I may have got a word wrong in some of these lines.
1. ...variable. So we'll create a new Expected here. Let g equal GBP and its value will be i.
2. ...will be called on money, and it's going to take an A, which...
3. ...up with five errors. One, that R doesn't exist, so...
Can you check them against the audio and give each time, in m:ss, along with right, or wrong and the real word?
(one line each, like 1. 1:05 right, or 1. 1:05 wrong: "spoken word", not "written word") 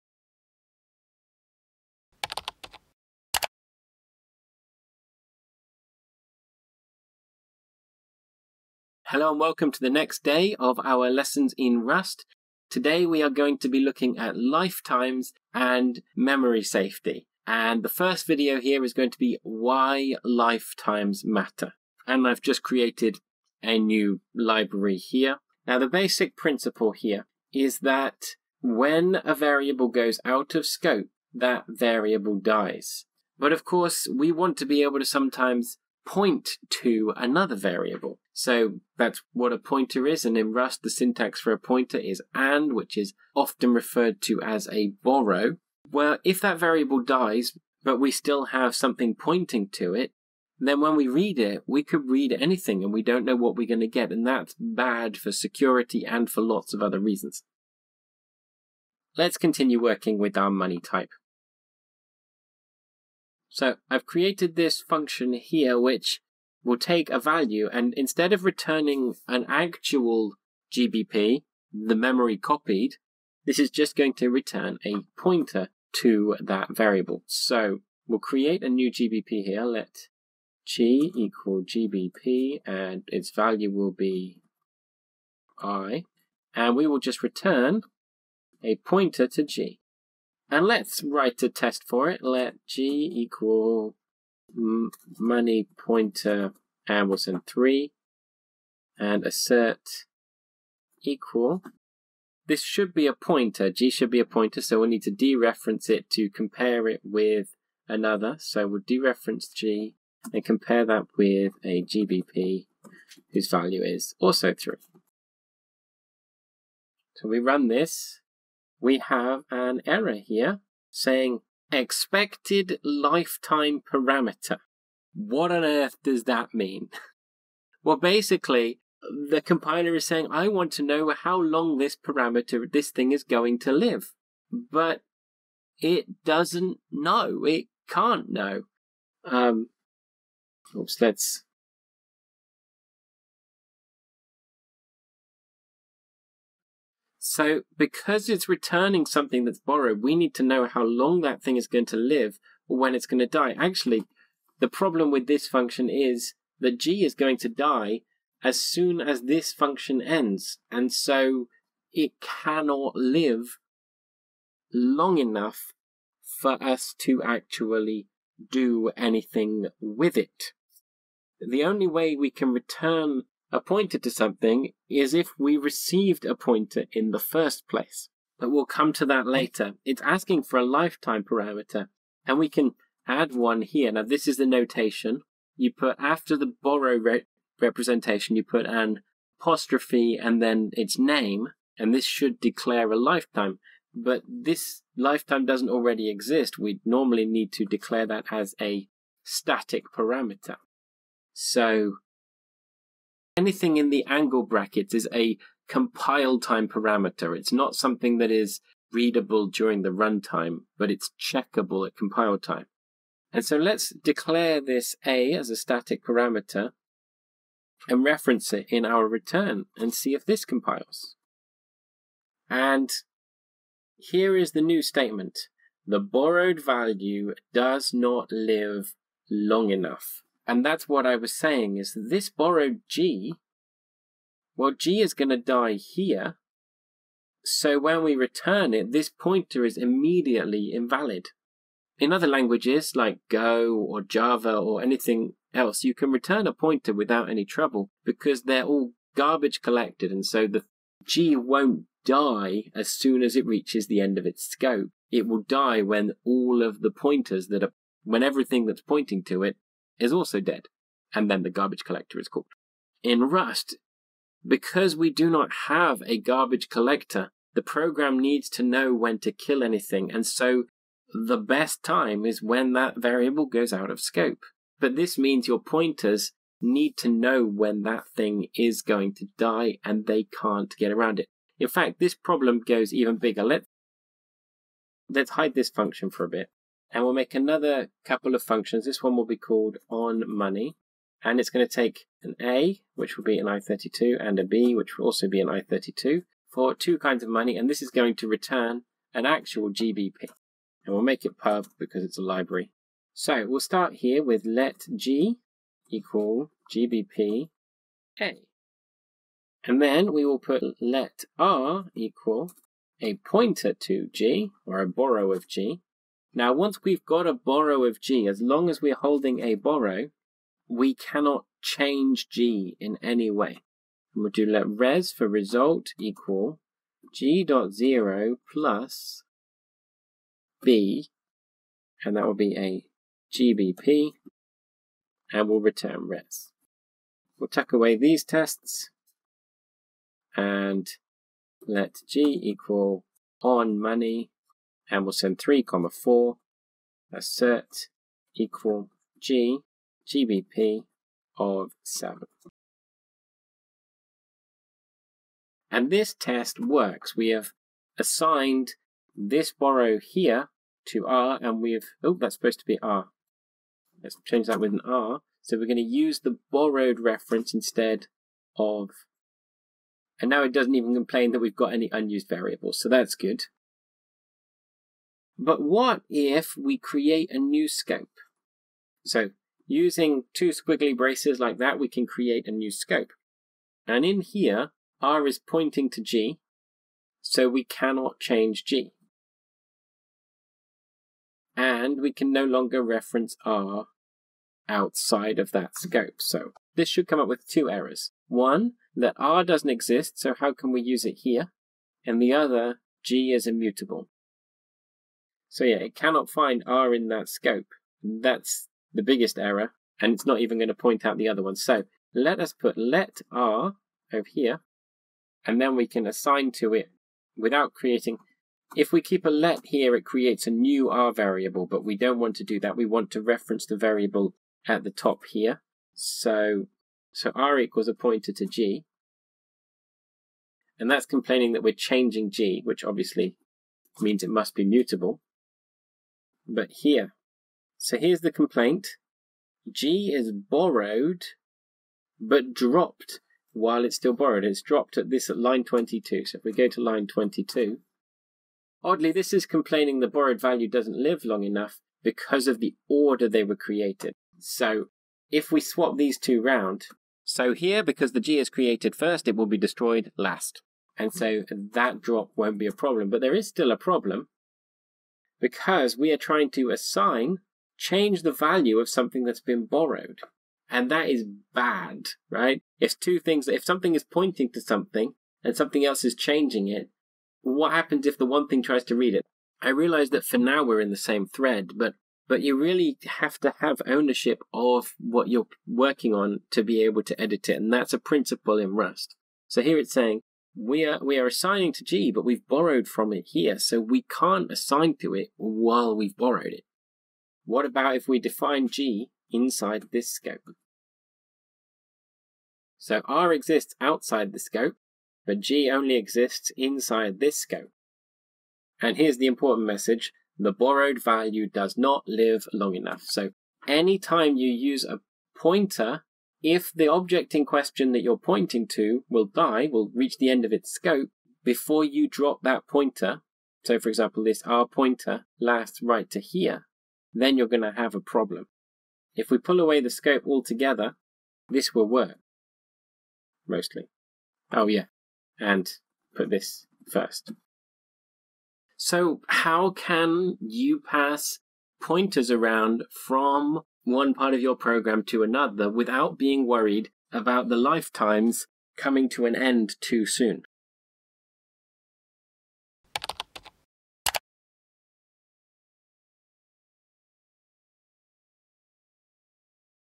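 1. 1:16 wrong: "GBP", not "Expected"
2. 4:49 right
3. 6:37 wrong: "two", not "five".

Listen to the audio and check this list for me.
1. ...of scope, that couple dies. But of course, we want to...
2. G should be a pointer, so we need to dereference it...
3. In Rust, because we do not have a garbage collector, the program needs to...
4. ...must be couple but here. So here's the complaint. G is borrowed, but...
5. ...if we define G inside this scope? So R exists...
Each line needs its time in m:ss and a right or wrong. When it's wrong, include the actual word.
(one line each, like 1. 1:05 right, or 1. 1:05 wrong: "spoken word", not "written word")
1. 0:30 wrong: "variable", not "couple"
2. 1:43 right
3. 4:23 right
4. 7:14 wrong: "mutable", not "couple"
5. 8:17 right.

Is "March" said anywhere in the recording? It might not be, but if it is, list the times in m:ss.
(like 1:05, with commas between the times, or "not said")
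not said.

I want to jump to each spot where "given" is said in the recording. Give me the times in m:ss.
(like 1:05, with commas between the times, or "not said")
not said.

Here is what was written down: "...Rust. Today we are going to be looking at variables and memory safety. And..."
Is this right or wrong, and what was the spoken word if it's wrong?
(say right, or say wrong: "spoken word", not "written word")
wrong: "lifetimes", not "variables".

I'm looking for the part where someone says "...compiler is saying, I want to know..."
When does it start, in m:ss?
2:09.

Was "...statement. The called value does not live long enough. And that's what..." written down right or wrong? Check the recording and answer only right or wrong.
wrong.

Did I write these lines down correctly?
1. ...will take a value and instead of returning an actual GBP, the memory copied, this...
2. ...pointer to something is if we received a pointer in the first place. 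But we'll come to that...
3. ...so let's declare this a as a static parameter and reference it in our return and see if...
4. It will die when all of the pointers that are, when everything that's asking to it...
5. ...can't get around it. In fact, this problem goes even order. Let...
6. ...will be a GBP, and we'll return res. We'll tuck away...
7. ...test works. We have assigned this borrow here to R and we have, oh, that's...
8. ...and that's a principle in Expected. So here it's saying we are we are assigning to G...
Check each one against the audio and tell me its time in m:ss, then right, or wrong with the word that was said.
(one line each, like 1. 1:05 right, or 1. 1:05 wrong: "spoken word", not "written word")
1. 1:06 right
2. 2:53 right
3. 3:33 right
4. 4:15 wrong: "pointing", not "asking"
5. 4:40 wrong: "bigger", not "order"
6. 5:32 right
7. 5:56 right
8. 8:07 wrong: "Rust", not "Expected".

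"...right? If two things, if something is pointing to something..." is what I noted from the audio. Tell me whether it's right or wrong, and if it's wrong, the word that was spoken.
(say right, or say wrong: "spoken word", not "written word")
right.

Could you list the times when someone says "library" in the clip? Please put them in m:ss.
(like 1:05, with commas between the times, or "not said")
0:24, 5:02.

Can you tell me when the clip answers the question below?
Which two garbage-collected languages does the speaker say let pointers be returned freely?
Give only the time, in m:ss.
4:03.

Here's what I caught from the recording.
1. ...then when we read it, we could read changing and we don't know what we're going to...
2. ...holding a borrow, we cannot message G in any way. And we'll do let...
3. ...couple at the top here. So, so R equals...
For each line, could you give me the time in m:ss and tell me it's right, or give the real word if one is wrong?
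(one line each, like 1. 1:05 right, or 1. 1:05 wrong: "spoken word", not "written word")
1. 0:50 wrong: "anything", not "changing"
2. 5:18 wrong: "change", not "message"
3. 7:03 wrong: "variable", not "couple".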